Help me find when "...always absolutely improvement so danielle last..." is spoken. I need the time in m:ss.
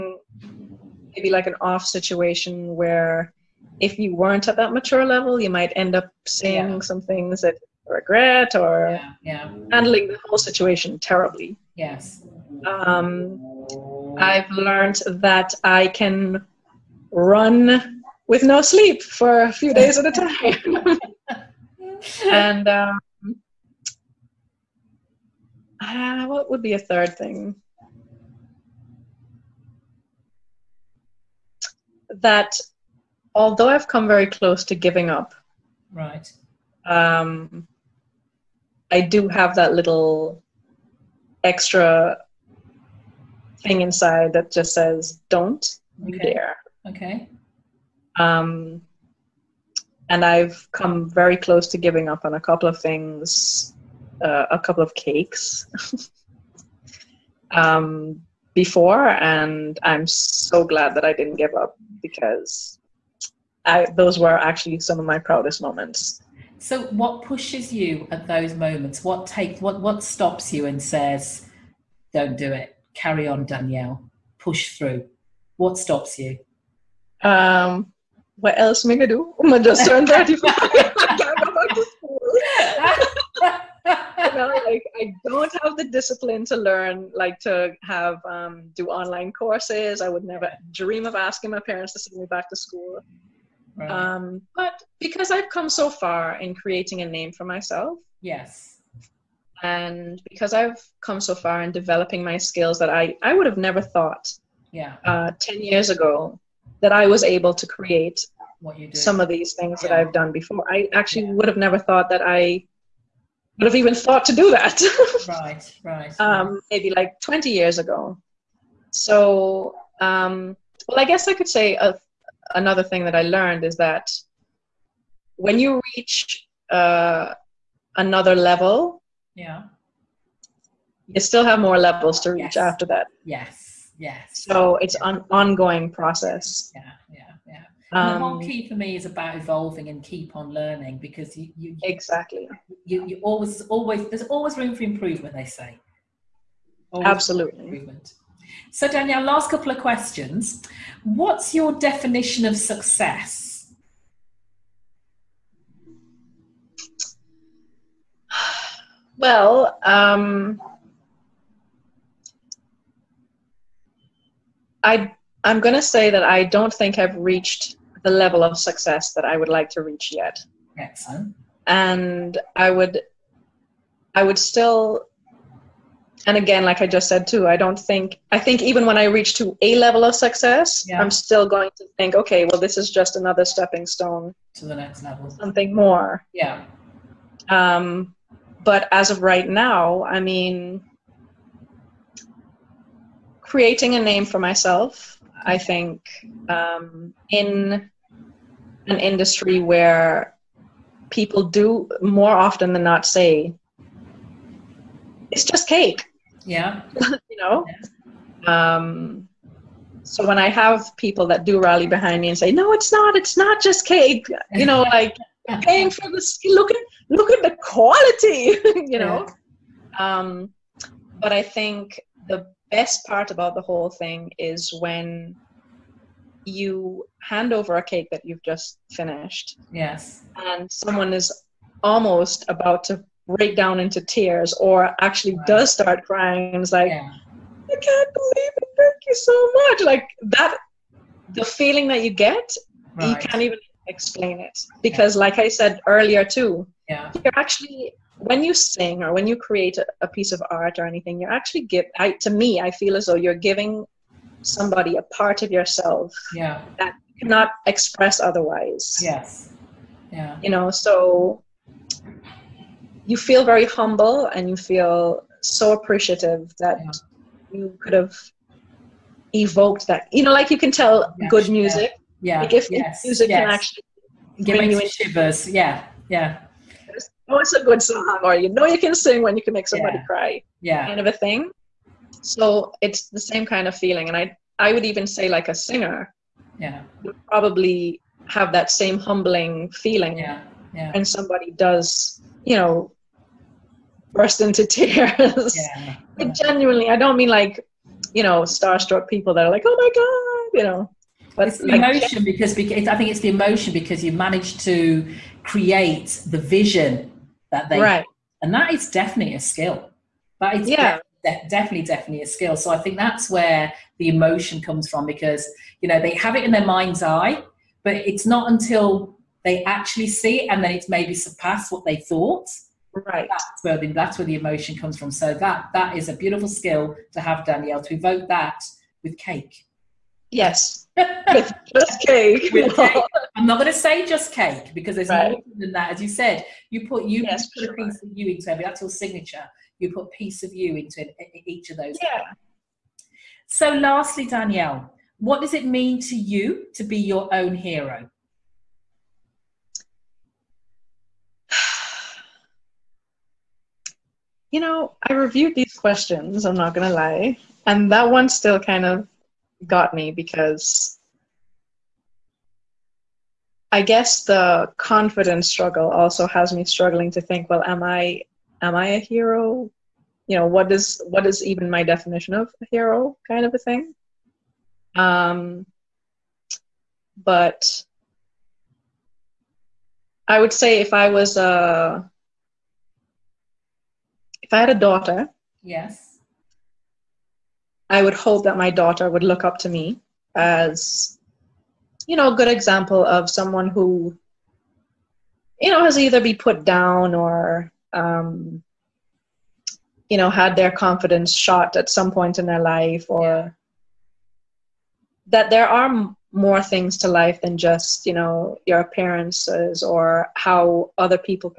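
2:26.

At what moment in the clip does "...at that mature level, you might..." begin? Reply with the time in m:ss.
0:04.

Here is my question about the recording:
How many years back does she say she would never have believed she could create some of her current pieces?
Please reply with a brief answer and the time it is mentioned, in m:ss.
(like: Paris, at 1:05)
10 years, at 1:45.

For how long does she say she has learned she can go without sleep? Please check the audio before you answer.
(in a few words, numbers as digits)
a few days.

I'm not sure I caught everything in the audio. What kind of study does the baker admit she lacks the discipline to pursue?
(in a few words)
online courses.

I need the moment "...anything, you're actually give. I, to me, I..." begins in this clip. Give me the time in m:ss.
4:10.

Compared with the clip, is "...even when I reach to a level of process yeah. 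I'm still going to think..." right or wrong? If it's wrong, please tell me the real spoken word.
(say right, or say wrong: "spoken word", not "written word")
wrong: "success", not "process".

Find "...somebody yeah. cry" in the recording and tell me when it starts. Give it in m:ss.
4:39.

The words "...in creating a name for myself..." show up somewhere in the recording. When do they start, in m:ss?
1:36.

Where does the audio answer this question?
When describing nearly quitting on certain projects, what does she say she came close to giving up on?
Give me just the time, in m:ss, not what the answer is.
0:54.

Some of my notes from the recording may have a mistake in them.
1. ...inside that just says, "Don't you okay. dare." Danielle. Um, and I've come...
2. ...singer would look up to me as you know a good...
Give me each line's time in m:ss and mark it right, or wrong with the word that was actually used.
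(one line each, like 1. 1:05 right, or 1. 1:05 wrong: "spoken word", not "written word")
1. 0:43 wrong: "Okay", not "Danielle"
2. 6:28 wrong: "daughter", not "singer".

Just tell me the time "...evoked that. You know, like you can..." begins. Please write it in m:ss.
4:29.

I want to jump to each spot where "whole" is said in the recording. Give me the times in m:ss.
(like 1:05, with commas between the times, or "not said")
0:10, 3:43.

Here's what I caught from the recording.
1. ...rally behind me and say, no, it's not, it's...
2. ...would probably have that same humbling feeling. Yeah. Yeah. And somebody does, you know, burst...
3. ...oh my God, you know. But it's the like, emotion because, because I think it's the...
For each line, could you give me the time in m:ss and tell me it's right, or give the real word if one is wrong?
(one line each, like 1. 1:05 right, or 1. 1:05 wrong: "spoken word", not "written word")
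1. 3:31 right
2. 4:47 right
3. 4:59 right.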